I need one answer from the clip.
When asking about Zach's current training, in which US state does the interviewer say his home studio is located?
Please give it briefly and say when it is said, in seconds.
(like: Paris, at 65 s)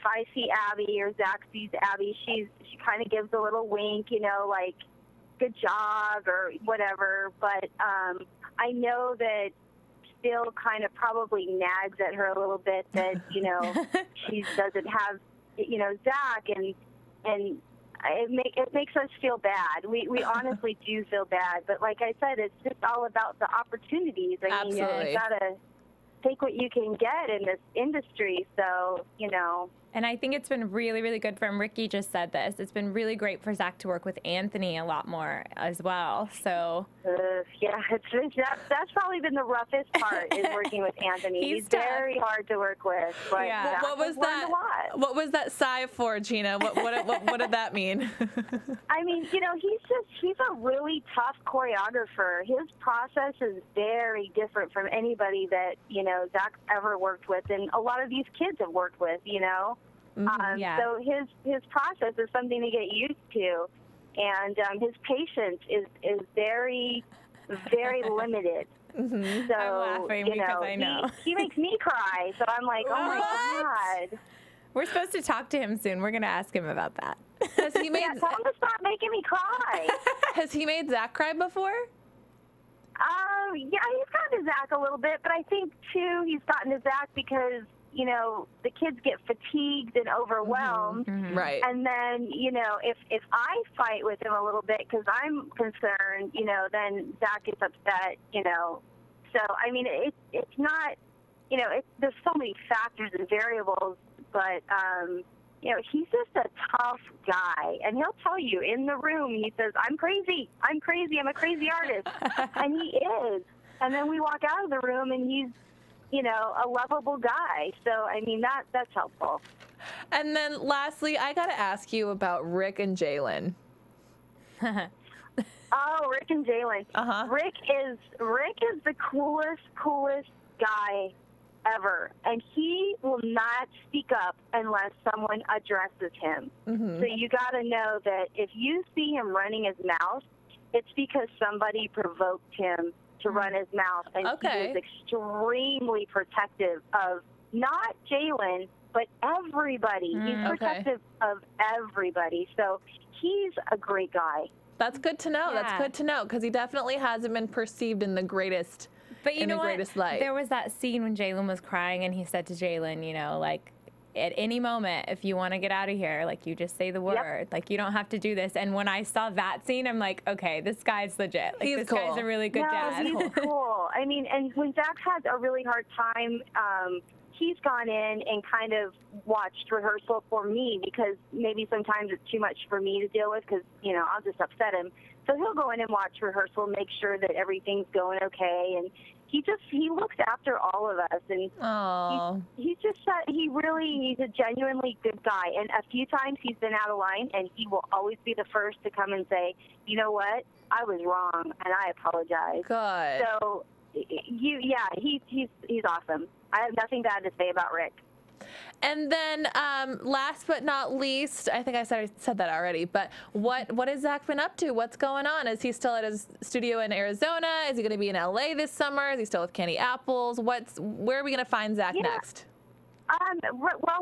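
Arizona, at 216 s.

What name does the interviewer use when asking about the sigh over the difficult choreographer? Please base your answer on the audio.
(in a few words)
Gina.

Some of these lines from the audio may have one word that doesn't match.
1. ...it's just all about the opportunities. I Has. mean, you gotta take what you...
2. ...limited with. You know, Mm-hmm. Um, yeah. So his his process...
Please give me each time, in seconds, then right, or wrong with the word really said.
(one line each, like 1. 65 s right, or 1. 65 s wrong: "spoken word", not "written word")
1. 22 s wrong: "Absolutely", not "Has"
2. 58 s wrong: "worked", not "limited".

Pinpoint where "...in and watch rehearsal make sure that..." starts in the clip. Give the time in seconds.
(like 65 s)
185 s.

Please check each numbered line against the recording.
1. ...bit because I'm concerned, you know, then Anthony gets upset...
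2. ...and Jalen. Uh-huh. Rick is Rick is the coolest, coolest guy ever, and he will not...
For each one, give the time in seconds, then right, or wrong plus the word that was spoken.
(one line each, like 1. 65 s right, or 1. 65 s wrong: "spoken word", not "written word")
1. 94 s wrong: "Zach", not "Anthony"
2. 126 s right.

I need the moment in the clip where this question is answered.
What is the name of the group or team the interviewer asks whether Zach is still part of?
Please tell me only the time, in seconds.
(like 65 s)
219 s.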